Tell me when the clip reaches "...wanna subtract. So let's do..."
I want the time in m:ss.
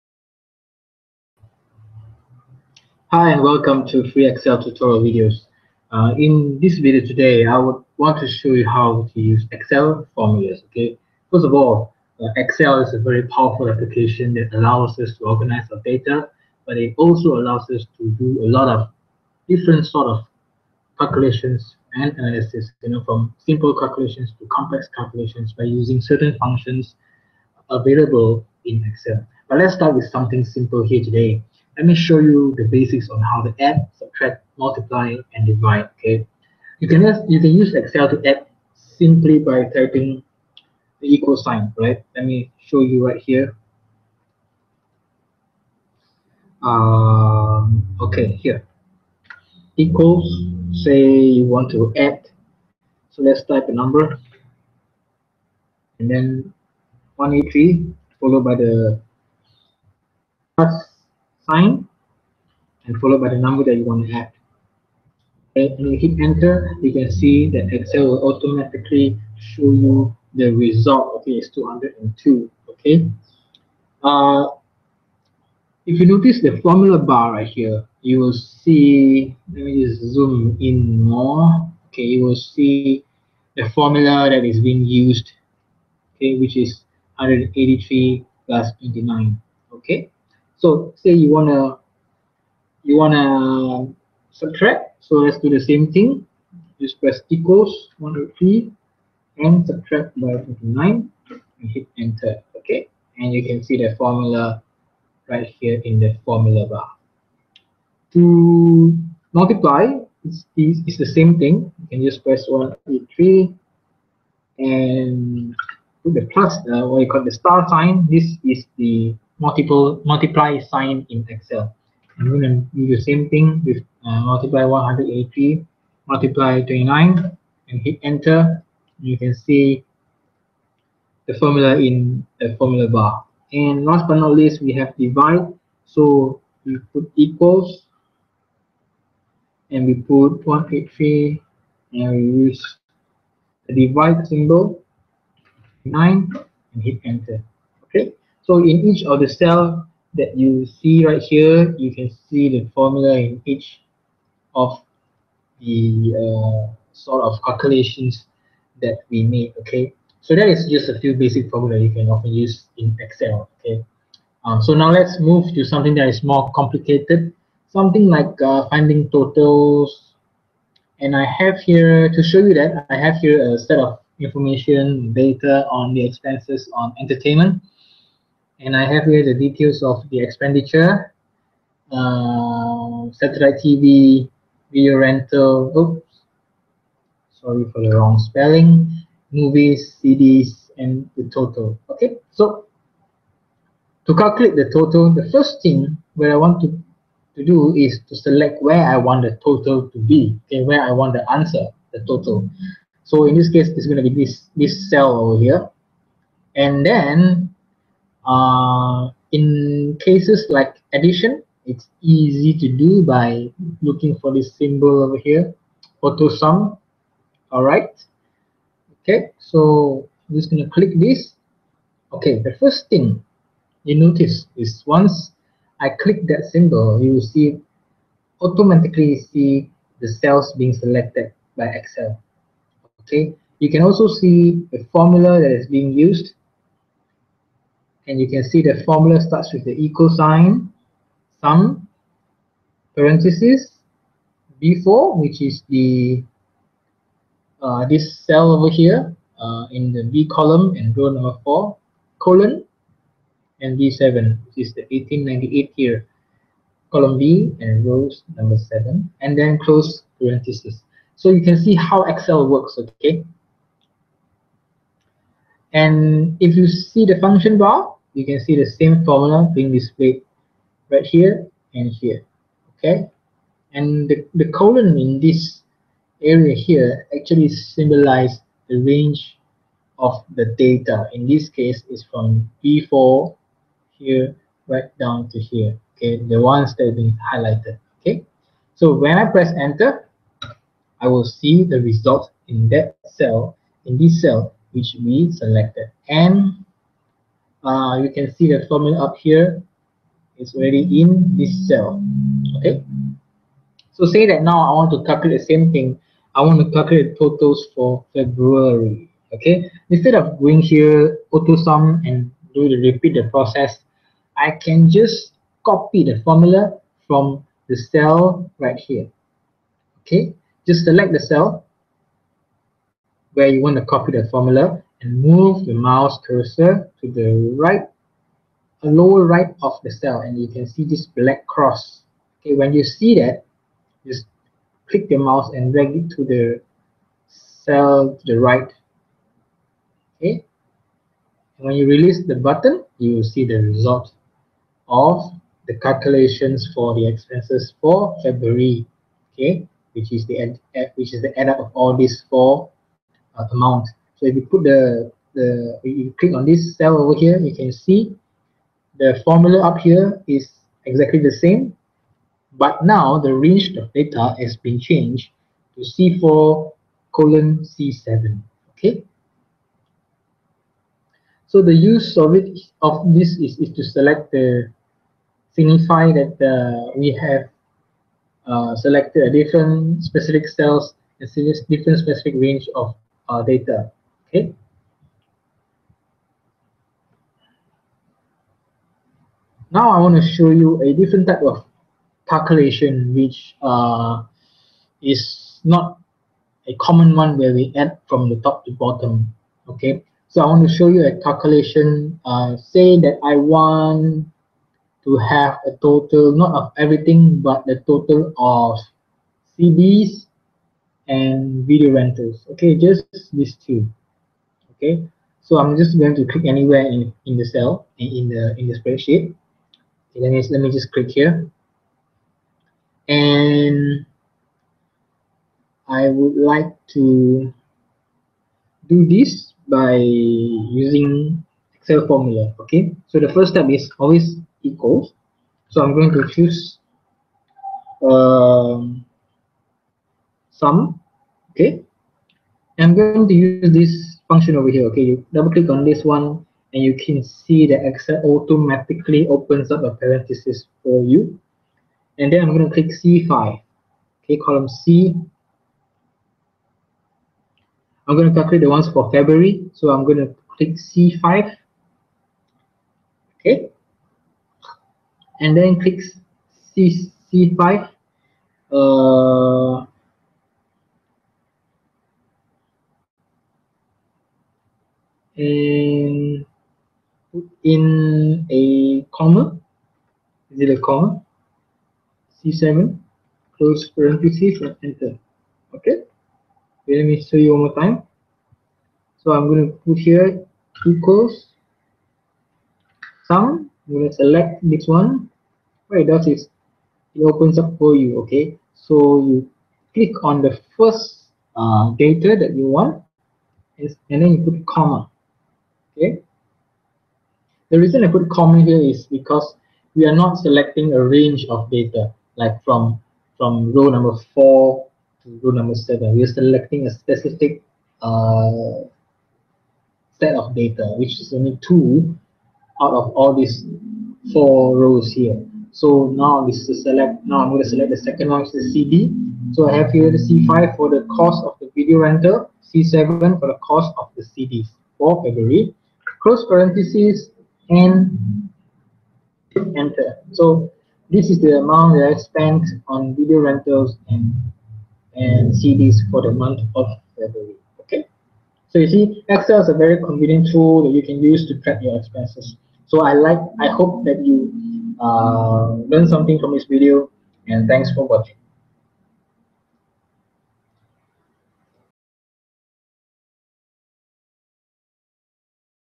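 1:32.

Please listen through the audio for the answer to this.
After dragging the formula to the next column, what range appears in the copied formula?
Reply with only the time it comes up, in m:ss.
6:05.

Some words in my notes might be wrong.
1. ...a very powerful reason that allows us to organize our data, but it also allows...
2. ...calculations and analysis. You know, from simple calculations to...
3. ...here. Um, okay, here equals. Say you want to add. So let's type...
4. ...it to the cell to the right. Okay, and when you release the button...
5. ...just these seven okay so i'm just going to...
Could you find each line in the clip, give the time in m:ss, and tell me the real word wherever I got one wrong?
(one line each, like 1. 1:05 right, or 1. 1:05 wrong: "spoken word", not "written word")
1. 0:12 wrong: "application", not "reason"
2. 0:20 right
3. 0:43 right
4. 5:35 right
5. 6:52 wrong: "two", not "seven".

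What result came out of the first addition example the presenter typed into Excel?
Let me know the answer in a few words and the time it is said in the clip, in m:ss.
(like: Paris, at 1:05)
202, at 1:11.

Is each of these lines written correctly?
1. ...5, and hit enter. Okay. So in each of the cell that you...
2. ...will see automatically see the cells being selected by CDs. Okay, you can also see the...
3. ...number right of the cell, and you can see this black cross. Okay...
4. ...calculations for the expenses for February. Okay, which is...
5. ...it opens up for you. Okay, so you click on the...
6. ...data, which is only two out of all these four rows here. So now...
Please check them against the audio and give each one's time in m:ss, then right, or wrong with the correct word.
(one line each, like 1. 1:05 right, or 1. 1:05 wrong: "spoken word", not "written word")
1. 2:25 wrong: "9", not "5"
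2. 3:47 wrong: "Excel", not "CDs"
3. 5:28 wrong: "lower", not "number"
4. 5:45 right
5. 8:17 right
6. 8:40 right.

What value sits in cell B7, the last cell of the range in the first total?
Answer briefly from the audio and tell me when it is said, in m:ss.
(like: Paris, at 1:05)
1898, at 4:14.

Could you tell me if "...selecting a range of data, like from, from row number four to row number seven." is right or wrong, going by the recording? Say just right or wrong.
right.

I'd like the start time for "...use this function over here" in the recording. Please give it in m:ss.
7:23.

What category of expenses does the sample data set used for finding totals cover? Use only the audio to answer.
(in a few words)
entertainment.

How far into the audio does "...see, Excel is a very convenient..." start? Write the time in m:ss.
9:08.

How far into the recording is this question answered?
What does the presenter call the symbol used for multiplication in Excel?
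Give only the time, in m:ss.
1:57.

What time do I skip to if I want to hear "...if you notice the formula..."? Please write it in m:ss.
1:15.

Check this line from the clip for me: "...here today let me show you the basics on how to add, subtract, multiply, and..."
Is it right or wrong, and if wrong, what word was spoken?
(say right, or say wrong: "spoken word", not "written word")
right.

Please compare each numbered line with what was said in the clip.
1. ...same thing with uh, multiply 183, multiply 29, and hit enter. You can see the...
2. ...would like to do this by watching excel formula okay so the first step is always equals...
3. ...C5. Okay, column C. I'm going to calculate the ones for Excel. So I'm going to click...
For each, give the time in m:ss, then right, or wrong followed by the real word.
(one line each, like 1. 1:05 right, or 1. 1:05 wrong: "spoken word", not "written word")
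1. 2:03 right
2. 7:06 wrong: "using", not "watching"
3. 7:33 wrong: "February", not "Excel".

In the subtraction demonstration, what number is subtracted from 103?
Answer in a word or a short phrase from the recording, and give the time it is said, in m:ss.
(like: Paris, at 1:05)
9, at 1:40.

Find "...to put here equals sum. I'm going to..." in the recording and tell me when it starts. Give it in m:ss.
8:09.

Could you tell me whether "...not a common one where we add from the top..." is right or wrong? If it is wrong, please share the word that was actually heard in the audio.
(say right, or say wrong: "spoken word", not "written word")
right.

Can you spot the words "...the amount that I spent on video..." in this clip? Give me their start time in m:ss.
9:01.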